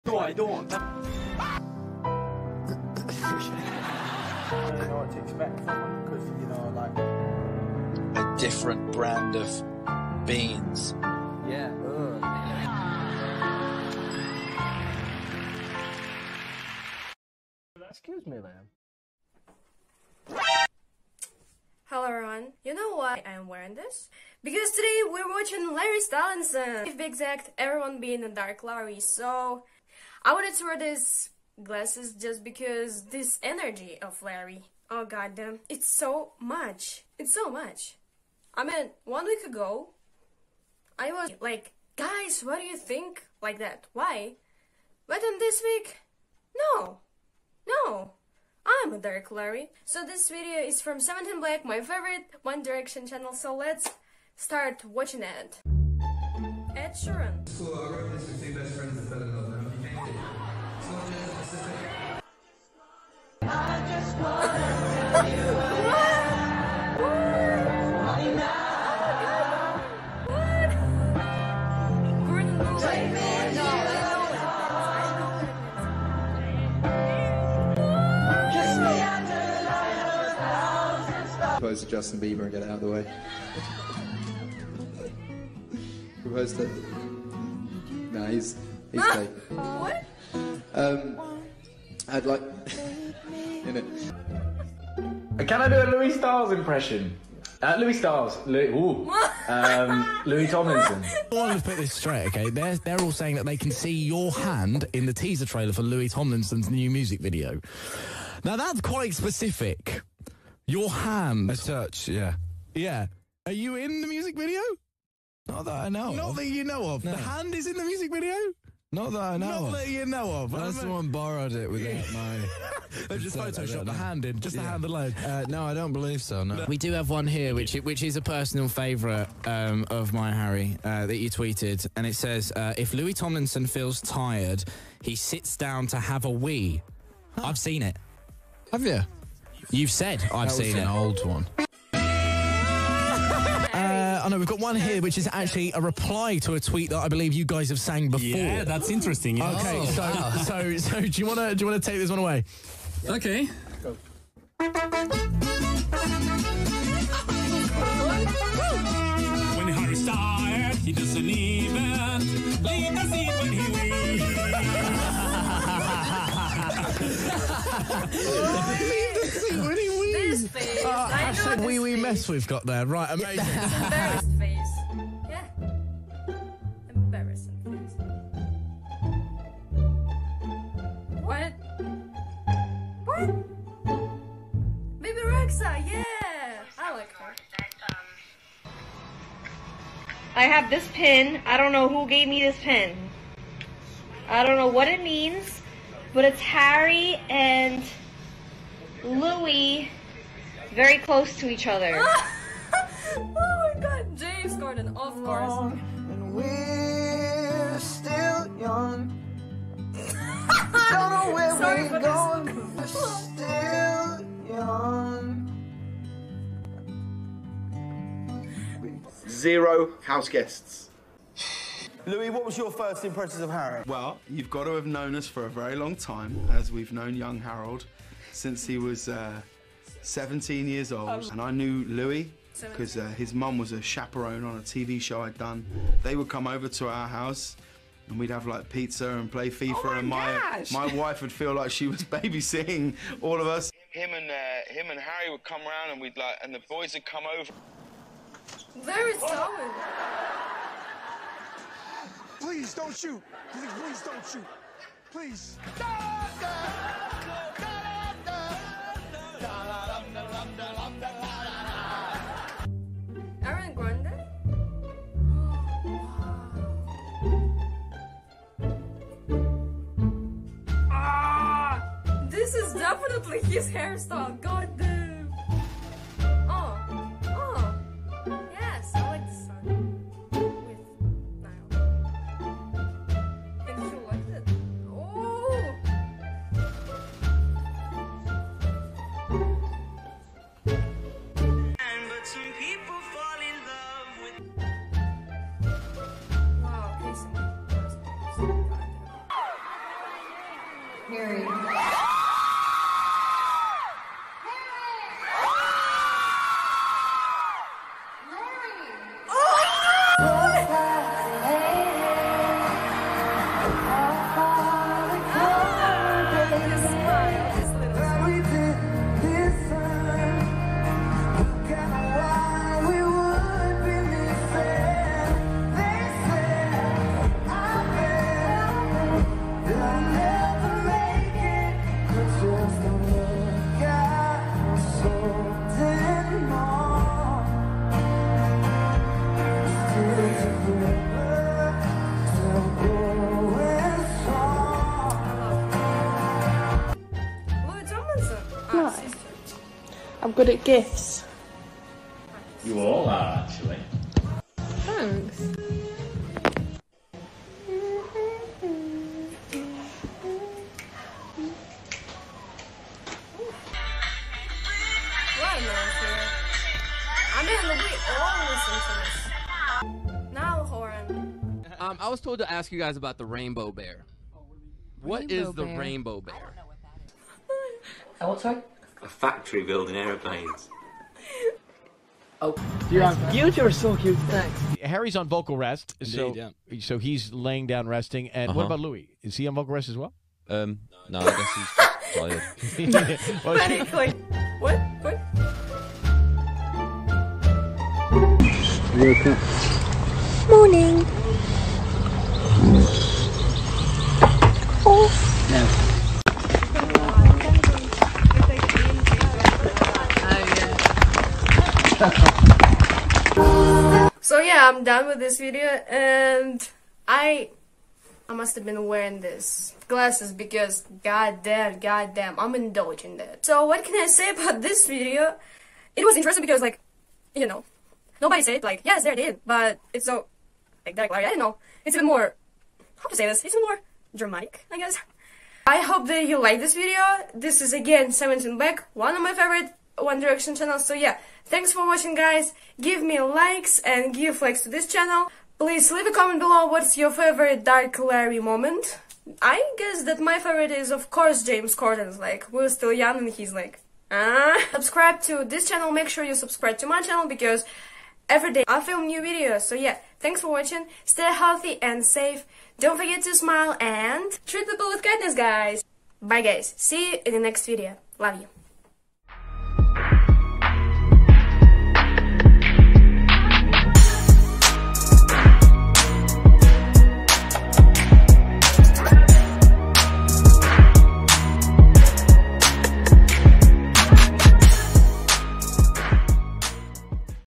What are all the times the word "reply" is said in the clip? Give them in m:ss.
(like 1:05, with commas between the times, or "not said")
2:25.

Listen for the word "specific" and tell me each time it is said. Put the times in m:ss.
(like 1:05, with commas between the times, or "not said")
1:49.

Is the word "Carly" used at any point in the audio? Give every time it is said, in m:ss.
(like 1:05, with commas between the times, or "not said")
not said.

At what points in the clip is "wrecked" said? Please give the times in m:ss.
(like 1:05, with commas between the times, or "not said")
not said.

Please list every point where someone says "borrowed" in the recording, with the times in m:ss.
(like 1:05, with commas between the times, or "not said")
2:01.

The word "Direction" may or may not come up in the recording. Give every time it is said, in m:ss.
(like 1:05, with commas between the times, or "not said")
0:52, 7:20.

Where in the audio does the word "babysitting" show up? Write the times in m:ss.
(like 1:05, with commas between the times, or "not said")
4:02.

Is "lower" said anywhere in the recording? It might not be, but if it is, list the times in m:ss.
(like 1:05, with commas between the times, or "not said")
not said.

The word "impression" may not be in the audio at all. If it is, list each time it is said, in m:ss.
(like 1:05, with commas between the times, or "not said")
1:36, 3:43.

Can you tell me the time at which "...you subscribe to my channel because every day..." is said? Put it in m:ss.
7:36.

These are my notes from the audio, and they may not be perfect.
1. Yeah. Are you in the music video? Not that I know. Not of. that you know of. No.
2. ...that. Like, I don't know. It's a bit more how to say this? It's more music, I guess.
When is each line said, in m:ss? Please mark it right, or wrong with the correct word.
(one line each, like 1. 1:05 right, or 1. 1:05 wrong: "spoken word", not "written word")
1. 1:52 right
2. 7:10 wrong: "dramatic", not "music".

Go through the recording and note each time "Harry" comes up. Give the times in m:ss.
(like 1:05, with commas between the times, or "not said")
2:10, 3:16, 3:43, 4:04, 6:24.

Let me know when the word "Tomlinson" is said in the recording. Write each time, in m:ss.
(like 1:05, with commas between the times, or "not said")
1:40, 1:46, 2:13.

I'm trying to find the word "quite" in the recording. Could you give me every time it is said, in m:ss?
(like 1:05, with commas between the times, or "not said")
1:48.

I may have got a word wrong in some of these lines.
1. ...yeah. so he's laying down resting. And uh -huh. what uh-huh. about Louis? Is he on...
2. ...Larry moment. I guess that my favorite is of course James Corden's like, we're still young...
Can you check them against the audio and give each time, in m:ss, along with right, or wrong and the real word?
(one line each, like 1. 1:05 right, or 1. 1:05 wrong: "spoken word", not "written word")
1. 6:26 right
2. 7:27 right.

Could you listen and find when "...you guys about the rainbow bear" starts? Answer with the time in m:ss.
6:12.